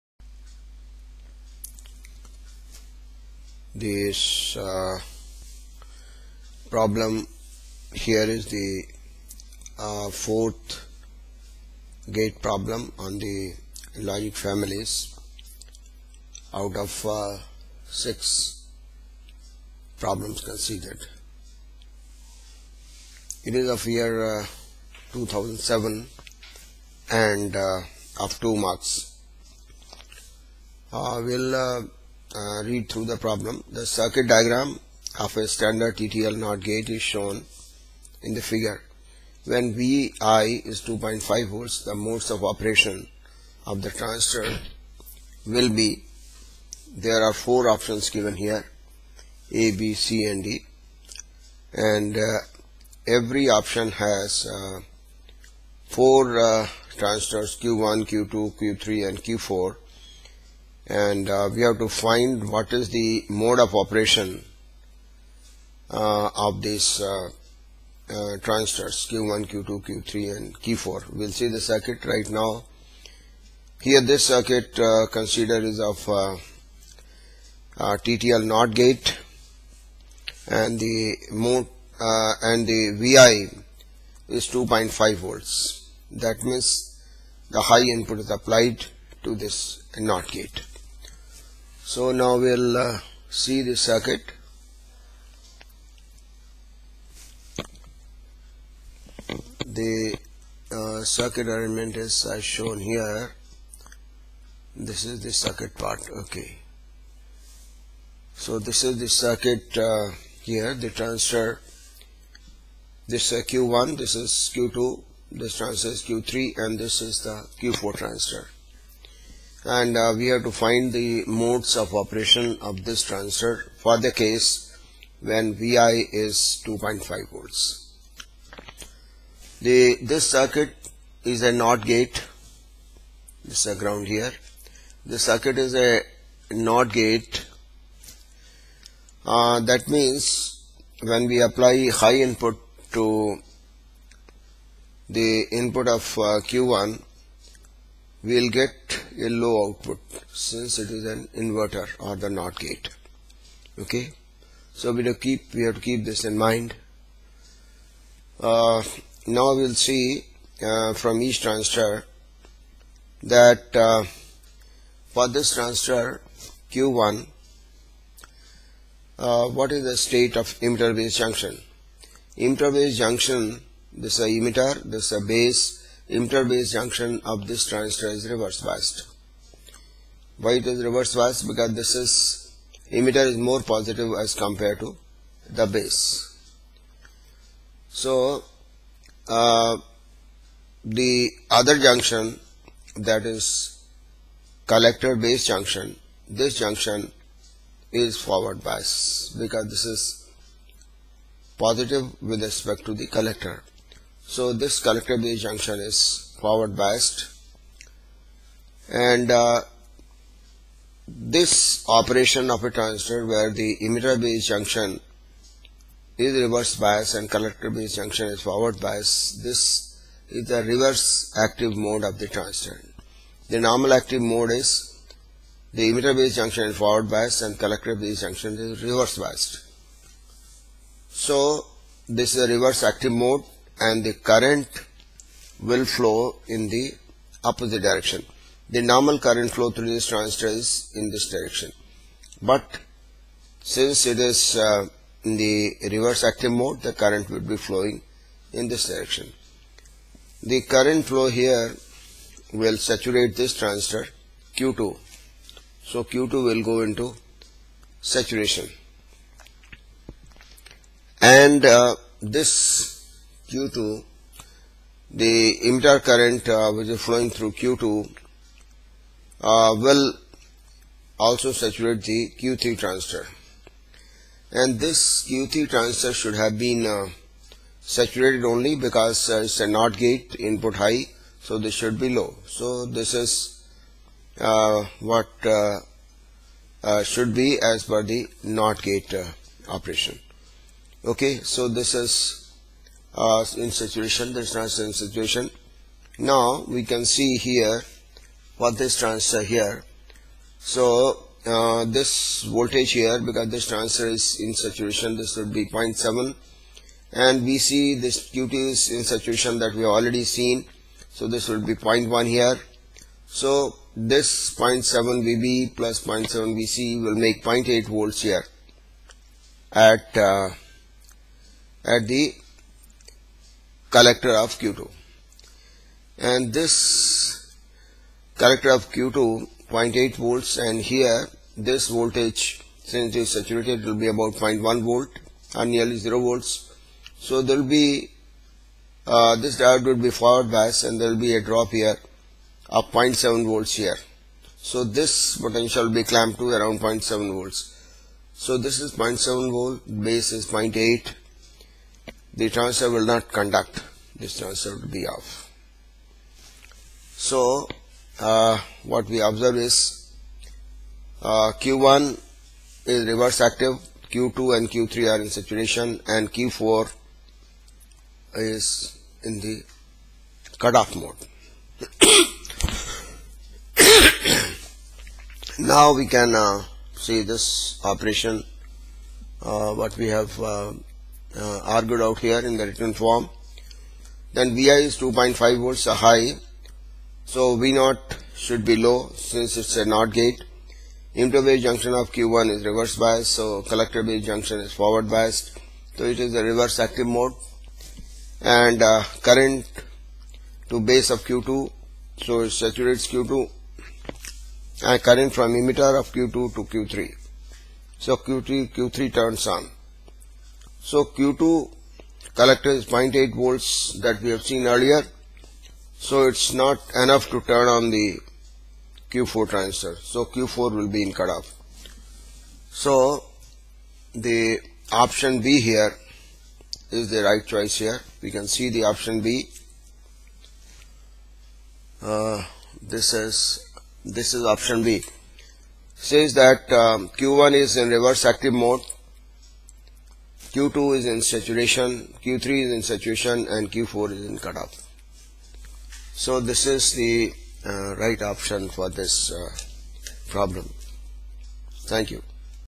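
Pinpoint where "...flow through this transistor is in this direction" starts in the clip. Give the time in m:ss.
3:59.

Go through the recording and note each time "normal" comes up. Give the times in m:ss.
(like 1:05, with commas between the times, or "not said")
3:43, 3:58.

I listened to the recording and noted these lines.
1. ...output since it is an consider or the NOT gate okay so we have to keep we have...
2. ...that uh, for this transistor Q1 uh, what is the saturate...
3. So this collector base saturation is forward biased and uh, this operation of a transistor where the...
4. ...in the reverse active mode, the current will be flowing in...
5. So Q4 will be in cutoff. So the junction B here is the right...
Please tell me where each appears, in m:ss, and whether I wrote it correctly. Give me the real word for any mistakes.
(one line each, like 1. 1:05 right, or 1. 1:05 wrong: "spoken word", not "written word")
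1. 2:29 wrong: "inverter", not "consider"
2. 2:43 wrong: "state", not "saturate"
3. 3:24 wrong: "junction", not "saturation"
4. 4:05 right
5. 6:59 wrong: "option", not "junction".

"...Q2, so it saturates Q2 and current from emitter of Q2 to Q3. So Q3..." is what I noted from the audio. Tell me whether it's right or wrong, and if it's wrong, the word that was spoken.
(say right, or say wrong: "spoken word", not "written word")
right.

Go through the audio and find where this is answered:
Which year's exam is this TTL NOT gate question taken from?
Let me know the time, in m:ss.
0:25.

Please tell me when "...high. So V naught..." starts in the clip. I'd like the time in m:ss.
6:25.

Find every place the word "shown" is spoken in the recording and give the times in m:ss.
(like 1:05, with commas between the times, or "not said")
0:37, 1:42.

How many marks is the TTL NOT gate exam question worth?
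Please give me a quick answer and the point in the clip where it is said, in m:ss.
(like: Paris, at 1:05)
2, at 0:28.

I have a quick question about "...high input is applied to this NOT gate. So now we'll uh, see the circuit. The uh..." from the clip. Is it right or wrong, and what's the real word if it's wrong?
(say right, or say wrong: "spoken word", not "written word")
right.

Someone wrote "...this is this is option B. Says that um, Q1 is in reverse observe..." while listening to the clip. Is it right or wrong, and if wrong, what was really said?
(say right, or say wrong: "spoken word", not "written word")
wrong: "active", not "observe".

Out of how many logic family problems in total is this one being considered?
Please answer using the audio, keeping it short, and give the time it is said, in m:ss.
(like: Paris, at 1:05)
6, at 0:17.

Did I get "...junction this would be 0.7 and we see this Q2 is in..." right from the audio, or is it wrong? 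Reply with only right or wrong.
wrong.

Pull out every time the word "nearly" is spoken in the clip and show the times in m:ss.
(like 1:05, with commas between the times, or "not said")
5:35.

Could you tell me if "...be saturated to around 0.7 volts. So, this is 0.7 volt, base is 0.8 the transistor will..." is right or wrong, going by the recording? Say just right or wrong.
wrong.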